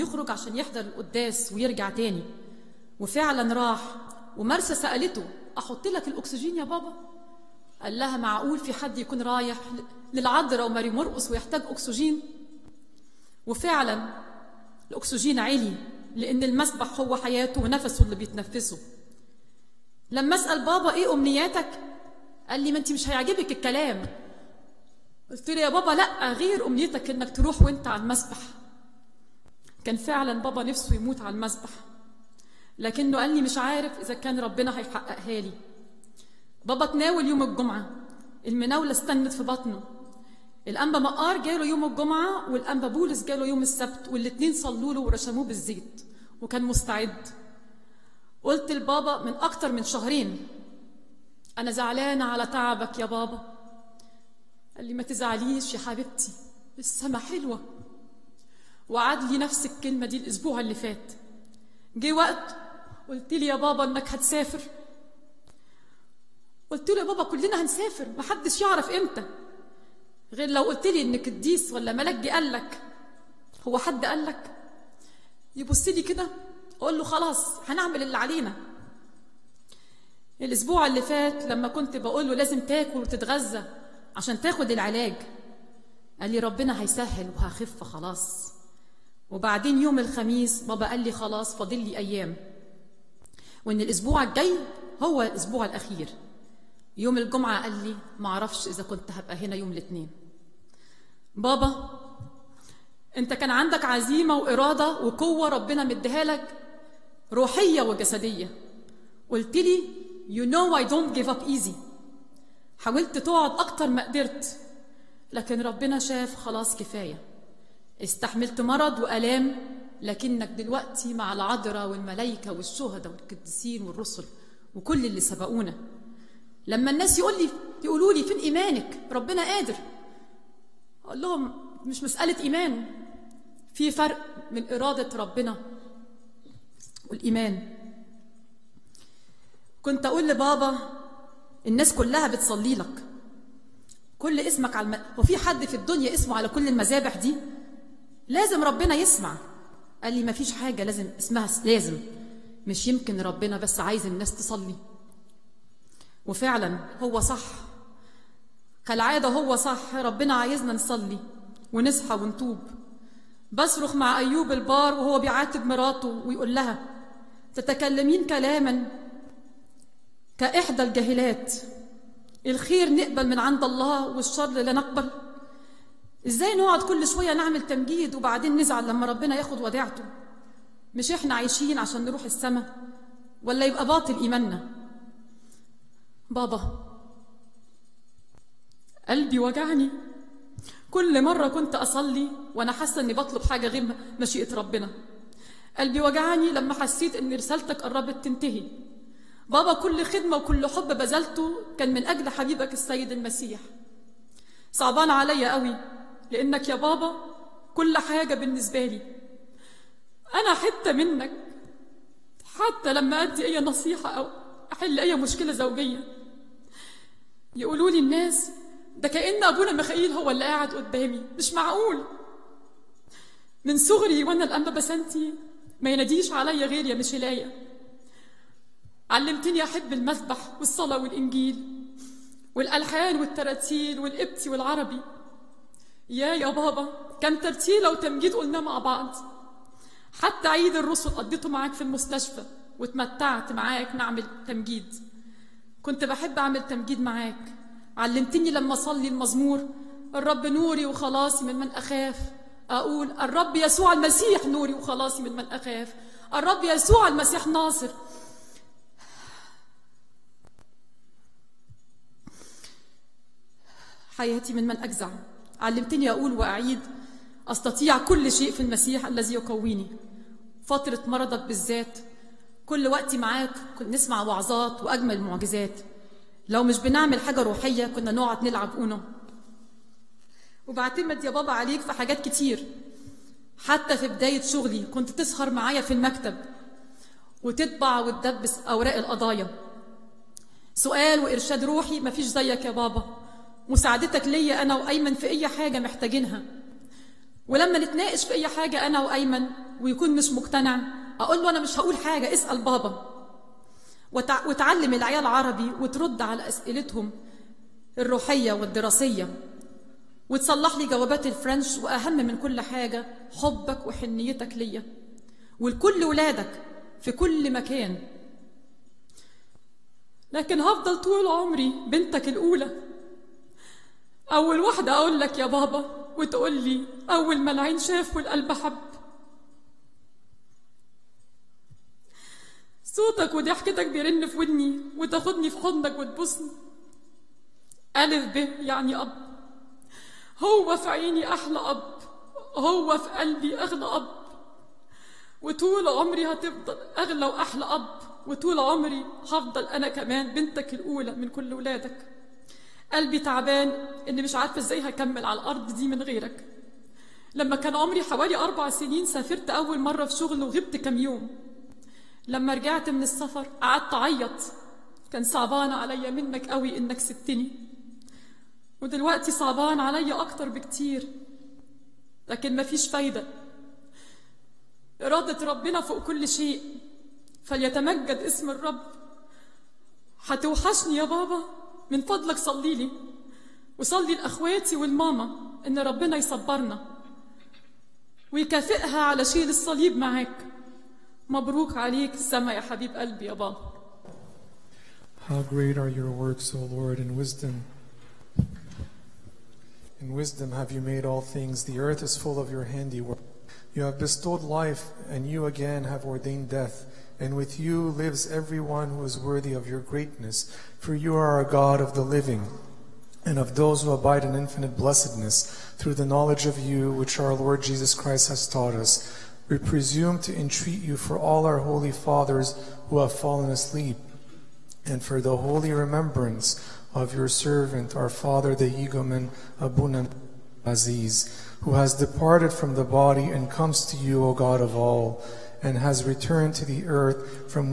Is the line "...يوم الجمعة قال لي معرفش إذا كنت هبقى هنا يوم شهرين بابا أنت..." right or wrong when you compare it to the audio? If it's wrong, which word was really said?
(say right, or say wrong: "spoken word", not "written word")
wrong: "الاثنين", not "شهرين".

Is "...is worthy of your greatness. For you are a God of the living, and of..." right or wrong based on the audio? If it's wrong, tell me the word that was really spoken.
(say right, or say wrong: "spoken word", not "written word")
right.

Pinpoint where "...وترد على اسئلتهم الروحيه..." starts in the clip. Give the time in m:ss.
5:05.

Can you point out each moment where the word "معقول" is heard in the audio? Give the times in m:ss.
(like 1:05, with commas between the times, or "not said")
0:08, 3:41.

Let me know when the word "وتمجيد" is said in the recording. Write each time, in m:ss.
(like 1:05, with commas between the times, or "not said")
3:57.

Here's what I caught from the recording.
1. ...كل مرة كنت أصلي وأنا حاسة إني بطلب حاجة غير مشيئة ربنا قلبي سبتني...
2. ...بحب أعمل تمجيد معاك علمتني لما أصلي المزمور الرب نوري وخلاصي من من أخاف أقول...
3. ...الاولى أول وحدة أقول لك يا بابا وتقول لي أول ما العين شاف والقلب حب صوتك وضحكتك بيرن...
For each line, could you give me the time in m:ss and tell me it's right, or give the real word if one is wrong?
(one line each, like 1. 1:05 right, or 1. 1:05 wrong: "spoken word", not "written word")
1. 3:10 wrong: "وجعني", not "سبتني"
2. 4:06 right
3. 5:22 right.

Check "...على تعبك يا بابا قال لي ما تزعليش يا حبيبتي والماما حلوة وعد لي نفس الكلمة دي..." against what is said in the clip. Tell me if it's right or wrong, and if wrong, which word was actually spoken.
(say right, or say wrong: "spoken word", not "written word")
wrong: "السما", not "والماما".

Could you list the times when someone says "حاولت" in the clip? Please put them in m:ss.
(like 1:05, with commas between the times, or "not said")
1:52.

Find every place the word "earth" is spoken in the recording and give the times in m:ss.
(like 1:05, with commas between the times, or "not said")
6:41, 7:16.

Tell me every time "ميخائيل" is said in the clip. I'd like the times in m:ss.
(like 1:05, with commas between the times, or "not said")
3:39.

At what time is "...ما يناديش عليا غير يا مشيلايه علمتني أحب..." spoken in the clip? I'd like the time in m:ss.
3:45.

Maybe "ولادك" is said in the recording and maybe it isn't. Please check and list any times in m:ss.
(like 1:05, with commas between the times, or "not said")
5:16, 5:51.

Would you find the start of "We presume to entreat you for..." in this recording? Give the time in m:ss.
6:59.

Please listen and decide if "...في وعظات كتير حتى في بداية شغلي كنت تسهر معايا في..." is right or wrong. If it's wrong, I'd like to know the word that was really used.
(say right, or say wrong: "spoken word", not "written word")
wrong: "حاجات", not "وعظات".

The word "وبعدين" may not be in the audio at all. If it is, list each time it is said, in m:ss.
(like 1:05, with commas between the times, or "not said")
1:29, 2:58.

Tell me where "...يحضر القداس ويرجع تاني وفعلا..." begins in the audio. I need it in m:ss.
0:00.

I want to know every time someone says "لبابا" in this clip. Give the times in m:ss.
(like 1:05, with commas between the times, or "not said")
0:48, 2:20.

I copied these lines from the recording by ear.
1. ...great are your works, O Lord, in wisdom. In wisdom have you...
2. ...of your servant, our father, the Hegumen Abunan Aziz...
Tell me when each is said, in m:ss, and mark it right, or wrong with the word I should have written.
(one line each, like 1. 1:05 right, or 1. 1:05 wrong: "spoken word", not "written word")
1. 6:35 right
2. 7:06 right.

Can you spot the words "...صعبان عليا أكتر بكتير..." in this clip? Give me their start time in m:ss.
6:09.